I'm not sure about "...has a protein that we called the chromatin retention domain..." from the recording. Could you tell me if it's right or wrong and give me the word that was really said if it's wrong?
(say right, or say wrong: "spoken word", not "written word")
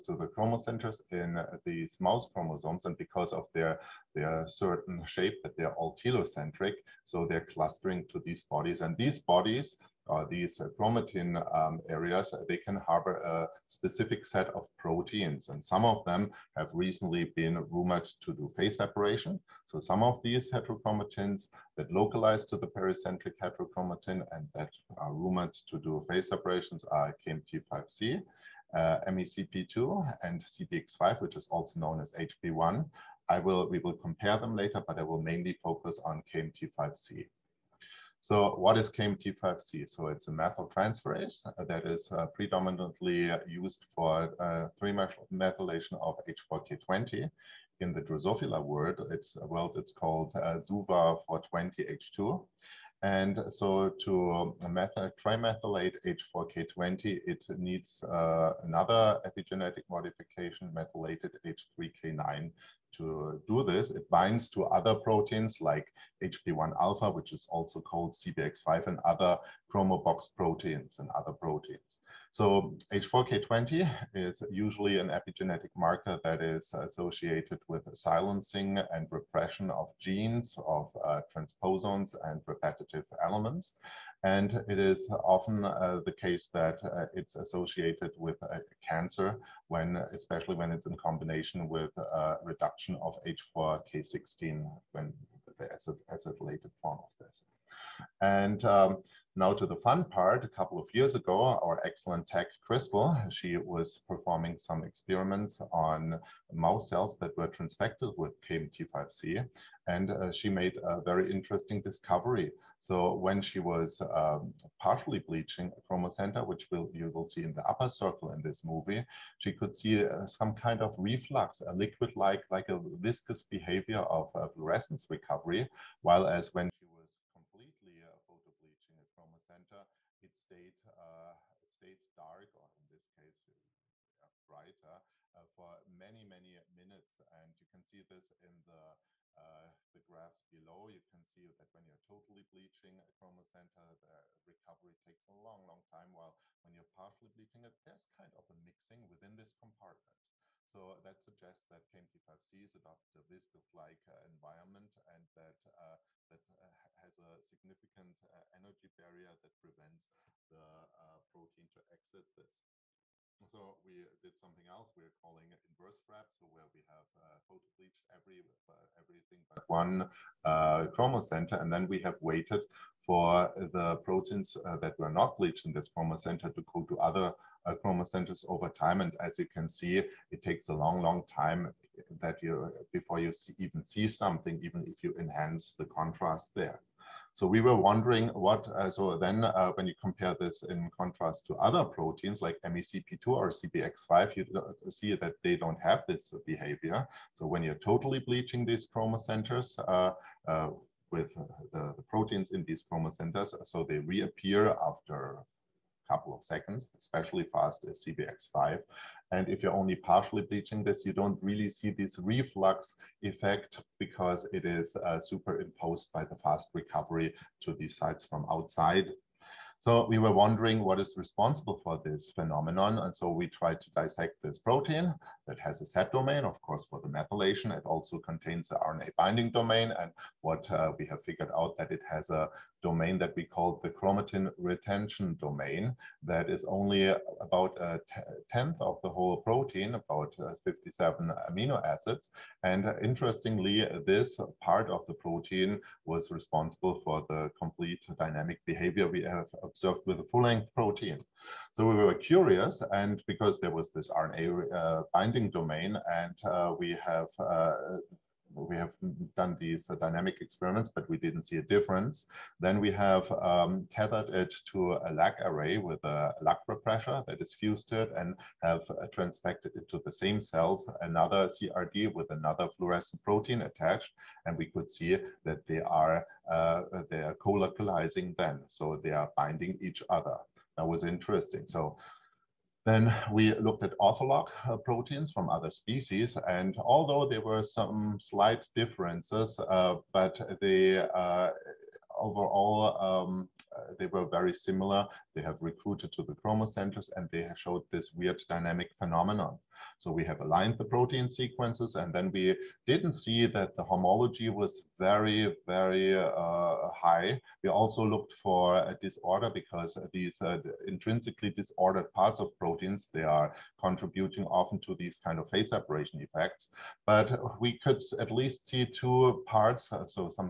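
wrong: "domain", not "protein".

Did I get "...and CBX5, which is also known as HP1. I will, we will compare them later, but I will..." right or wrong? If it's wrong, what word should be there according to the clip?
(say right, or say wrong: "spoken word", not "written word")
right.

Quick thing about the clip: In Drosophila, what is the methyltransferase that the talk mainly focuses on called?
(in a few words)
SUV420H2.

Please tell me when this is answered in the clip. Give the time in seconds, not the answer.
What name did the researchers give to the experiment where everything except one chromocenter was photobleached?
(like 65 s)
165 s.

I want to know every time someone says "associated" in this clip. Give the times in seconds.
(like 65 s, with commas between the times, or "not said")
76 s, 87 s.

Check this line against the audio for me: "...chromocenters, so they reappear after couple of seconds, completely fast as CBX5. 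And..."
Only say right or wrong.
wrong.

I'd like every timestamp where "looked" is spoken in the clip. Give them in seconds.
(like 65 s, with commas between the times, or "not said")
283 s, 308 s.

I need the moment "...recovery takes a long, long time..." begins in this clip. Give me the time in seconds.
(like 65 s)
144 s.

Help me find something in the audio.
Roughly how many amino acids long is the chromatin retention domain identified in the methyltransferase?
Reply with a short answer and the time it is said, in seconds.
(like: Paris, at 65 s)
57, at 240 s.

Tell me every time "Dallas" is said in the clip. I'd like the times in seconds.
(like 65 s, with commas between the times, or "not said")
not said.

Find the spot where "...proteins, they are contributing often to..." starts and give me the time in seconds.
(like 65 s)
312 s.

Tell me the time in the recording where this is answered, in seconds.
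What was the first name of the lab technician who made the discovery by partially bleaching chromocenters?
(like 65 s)
102 s.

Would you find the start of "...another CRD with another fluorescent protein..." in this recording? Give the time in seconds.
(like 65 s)
271 s.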